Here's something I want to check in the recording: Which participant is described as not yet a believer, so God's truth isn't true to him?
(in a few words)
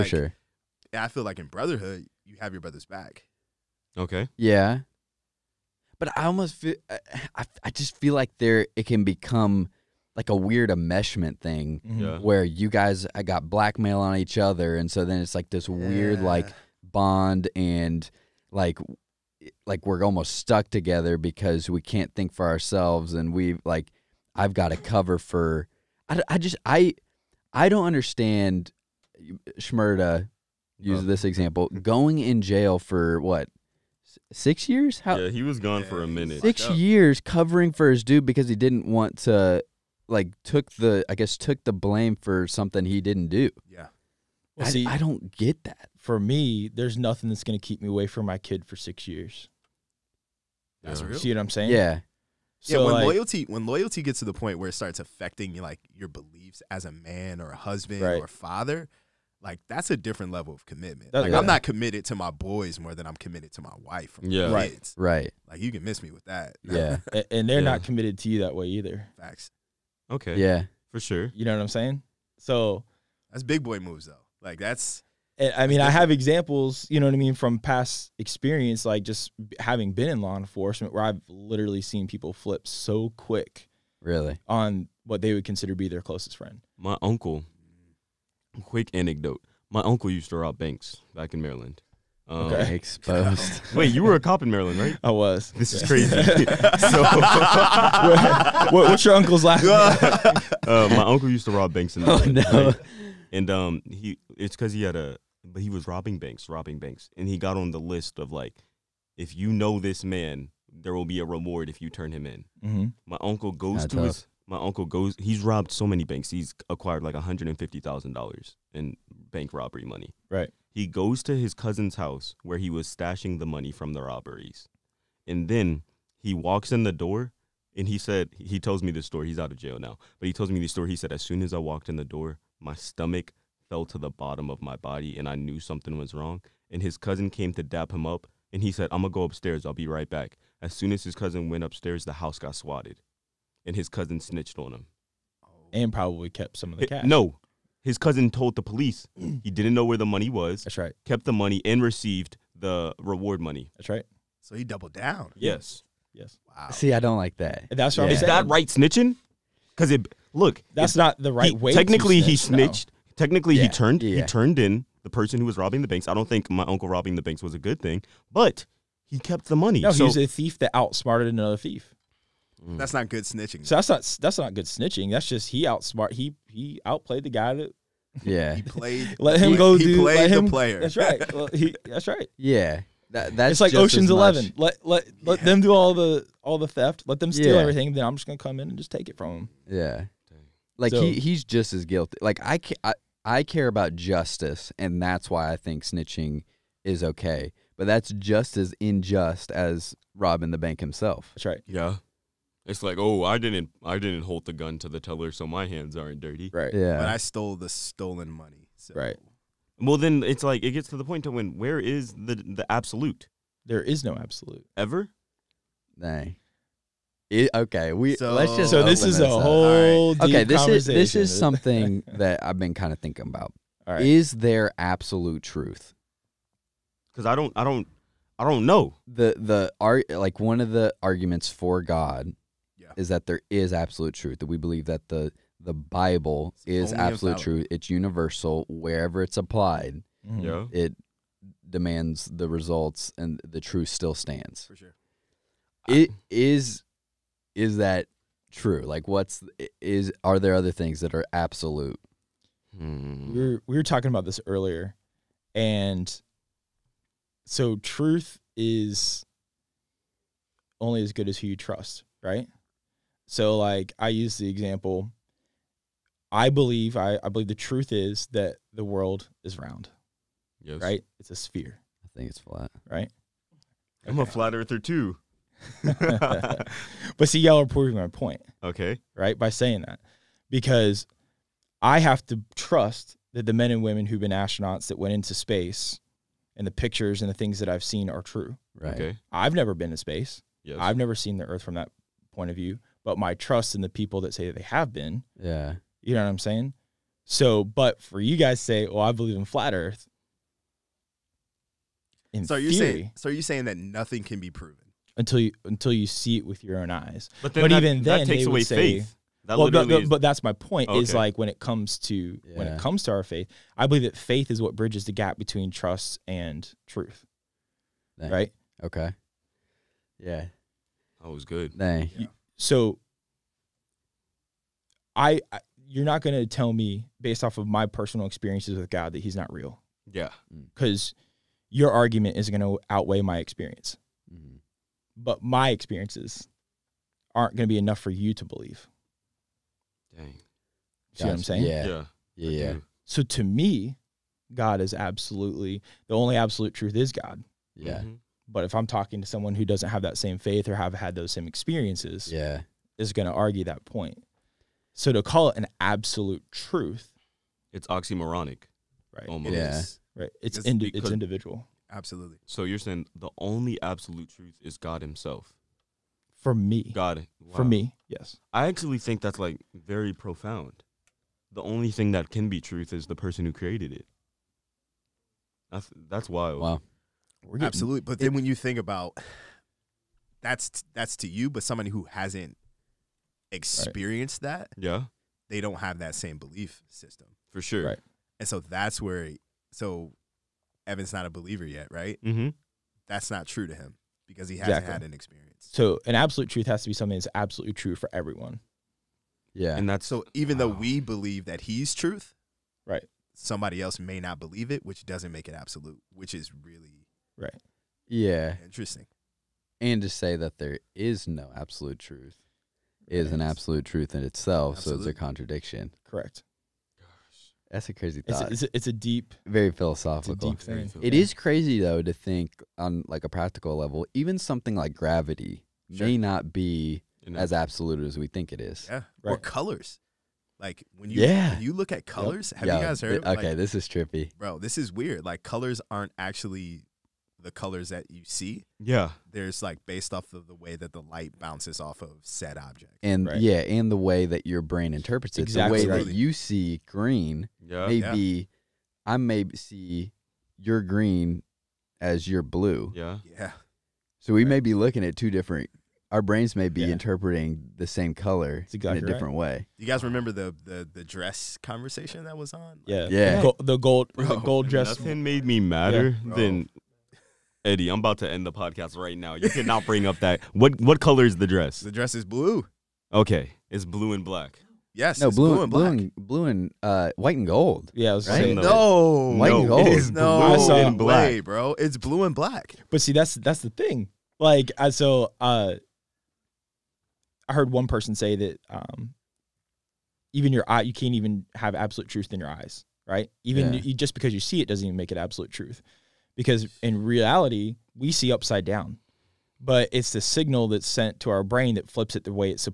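Evan.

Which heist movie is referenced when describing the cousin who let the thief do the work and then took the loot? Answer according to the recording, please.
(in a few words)
Ocean's Eleven.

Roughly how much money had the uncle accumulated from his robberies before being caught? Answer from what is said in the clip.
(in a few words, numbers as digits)
$150000.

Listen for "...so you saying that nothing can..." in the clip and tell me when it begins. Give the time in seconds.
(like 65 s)
303 s.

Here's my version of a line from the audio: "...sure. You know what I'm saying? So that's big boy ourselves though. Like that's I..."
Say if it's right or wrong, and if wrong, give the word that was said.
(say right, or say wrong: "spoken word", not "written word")
wrong: "moves", not "ourselves".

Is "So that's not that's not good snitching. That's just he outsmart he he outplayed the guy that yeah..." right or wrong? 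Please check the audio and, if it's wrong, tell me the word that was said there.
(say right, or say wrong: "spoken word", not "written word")
right.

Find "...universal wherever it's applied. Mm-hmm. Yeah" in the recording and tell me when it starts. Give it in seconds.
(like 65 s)
237 s.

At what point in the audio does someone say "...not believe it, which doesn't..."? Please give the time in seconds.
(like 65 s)
404 s.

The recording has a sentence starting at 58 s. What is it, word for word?
or a father, like that's a different level of commitment.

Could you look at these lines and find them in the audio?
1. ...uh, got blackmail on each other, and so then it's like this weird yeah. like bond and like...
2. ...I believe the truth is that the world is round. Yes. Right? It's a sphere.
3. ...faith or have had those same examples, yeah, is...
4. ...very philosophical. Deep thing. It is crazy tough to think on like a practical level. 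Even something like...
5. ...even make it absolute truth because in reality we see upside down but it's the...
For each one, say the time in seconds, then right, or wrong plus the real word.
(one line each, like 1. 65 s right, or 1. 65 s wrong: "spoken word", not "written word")
1. 13 s right
2. 267 s right
3. 350 s wrong: "experiences", not "examples"
4. 419 s wrong: "though", not "tough"
5. 494 s right.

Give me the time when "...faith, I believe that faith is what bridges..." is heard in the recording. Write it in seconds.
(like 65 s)
313 s.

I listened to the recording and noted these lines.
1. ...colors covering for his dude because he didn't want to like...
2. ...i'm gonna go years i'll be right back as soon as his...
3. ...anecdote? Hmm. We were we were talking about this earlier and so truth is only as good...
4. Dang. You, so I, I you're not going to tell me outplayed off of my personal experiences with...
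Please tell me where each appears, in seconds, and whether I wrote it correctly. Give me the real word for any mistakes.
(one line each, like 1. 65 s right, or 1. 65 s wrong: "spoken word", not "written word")
1. 36 s wrong: "years", not "colors"
2. 138 s wrong: "upstairs", not "years"
3. 251 s wrong: "absolute", not "anecdote"
4. 321 s wrong: "based", not "outplayed".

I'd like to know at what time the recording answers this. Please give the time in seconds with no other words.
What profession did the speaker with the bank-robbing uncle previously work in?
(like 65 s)
80 s.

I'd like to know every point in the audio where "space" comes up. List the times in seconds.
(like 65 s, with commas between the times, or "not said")
285 s, 289 s.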